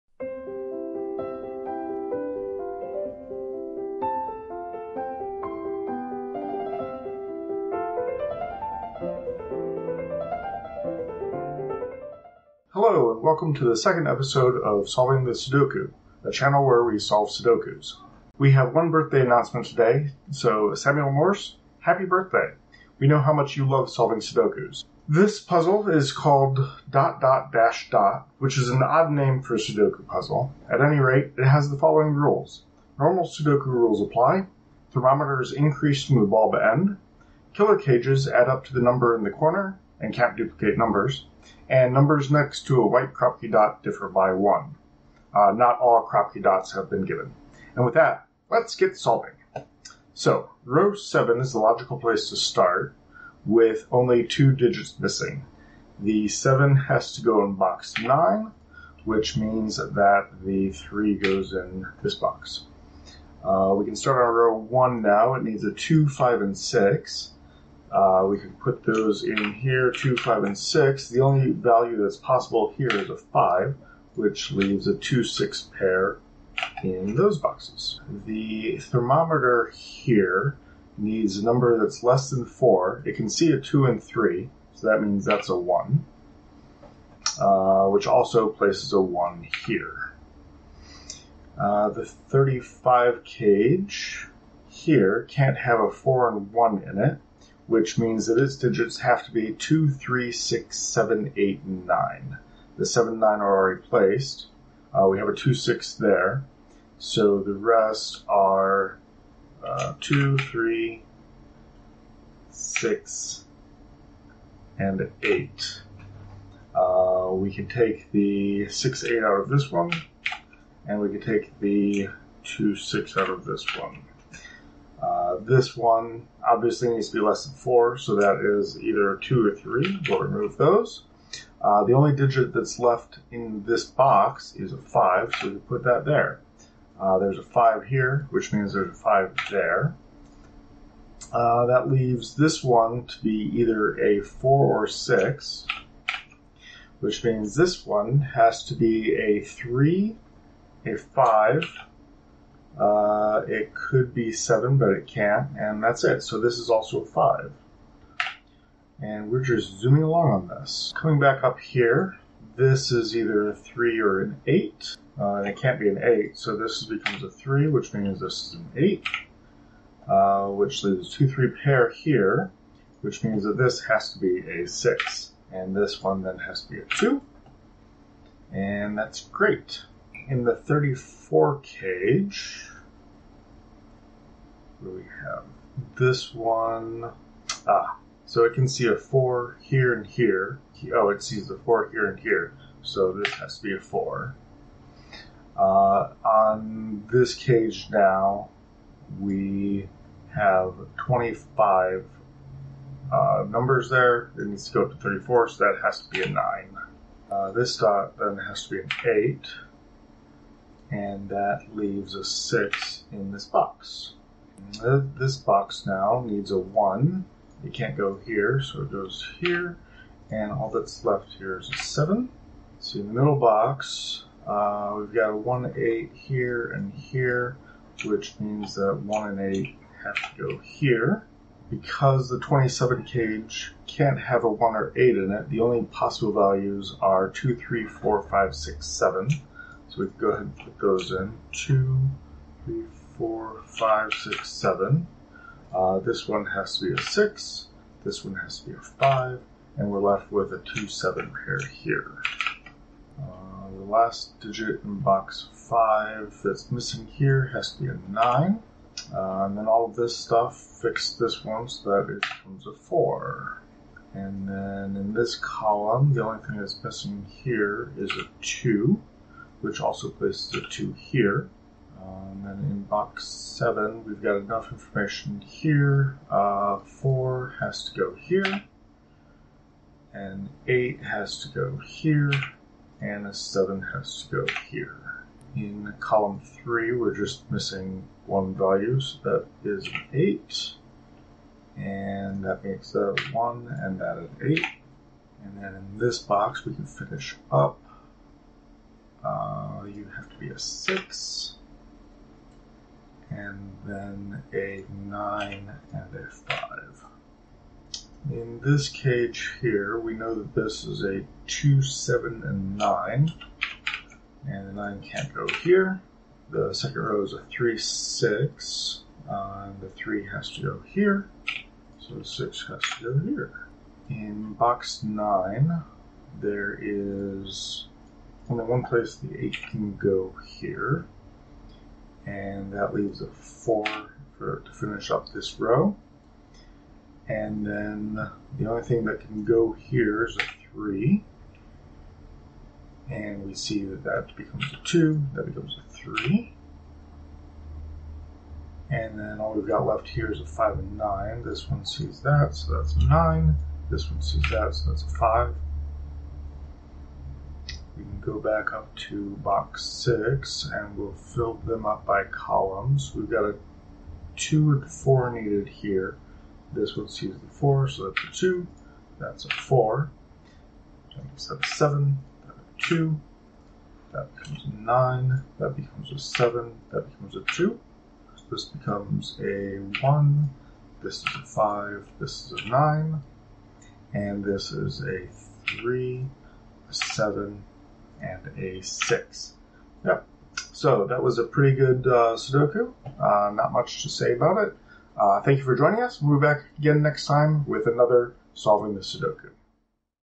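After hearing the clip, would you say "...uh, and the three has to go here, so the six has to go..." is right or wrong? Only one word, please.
right.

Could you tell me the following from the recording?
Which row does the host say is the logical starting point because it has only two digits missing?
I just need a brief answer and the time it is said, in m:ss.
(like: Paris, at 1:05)
Row 7, at 0:50.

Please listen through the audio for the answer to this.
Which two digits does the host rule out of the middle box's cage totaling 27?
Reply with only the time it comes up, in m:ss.
3:54.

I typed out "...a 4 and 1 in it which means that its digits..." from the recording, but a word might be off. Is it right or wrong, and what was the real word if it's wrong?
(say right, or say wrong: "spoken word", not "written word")
right.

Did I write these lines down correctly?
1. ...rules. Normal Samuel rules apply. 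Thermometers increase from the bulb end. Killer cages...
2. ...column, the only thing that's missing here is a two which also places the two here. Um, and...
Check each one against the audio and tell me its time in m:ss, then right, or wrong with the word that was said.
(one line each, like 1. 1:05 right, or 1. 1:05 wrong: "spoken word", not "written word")
1. 0:32 wrong: "Sudoku", not "Samuel"
2. 4:25 right.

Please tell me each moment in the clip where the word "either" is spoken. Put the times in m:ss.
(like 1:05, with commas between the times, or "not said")
2:08, 2:23, 2:43.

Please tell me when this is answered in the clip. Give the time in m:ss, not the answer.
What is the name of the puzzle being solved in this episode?
0:26.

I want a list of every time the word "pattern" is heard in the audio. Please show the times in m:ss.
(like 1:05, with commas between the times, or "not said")
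not said.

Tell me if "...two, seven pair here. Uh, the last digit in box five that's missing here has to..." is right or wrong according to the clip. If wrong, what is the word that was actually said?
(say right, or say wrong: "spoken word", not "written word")
right.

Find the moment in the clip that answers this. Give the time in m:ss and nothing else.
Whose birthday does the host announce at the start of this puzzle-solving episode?
0:20.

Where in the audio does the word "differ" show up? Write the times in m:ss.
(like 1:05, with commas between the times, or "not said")
0:43.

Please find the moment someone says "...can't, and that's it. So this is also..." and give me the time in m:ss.
2:35.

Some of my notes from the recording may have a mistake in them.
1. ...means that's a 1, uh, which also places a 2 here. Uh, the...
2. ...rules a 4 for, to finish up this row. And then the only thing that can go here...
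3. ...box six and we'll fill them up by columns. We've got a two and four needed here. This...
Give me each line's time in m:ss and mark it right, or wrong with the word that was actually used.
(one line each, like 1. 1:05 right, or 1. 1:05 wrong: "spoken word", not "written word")
1. 1:25 wrong: "1", not "2"
2. 5:32 wrong: "leaves", not "rules"
3. 5:59 right.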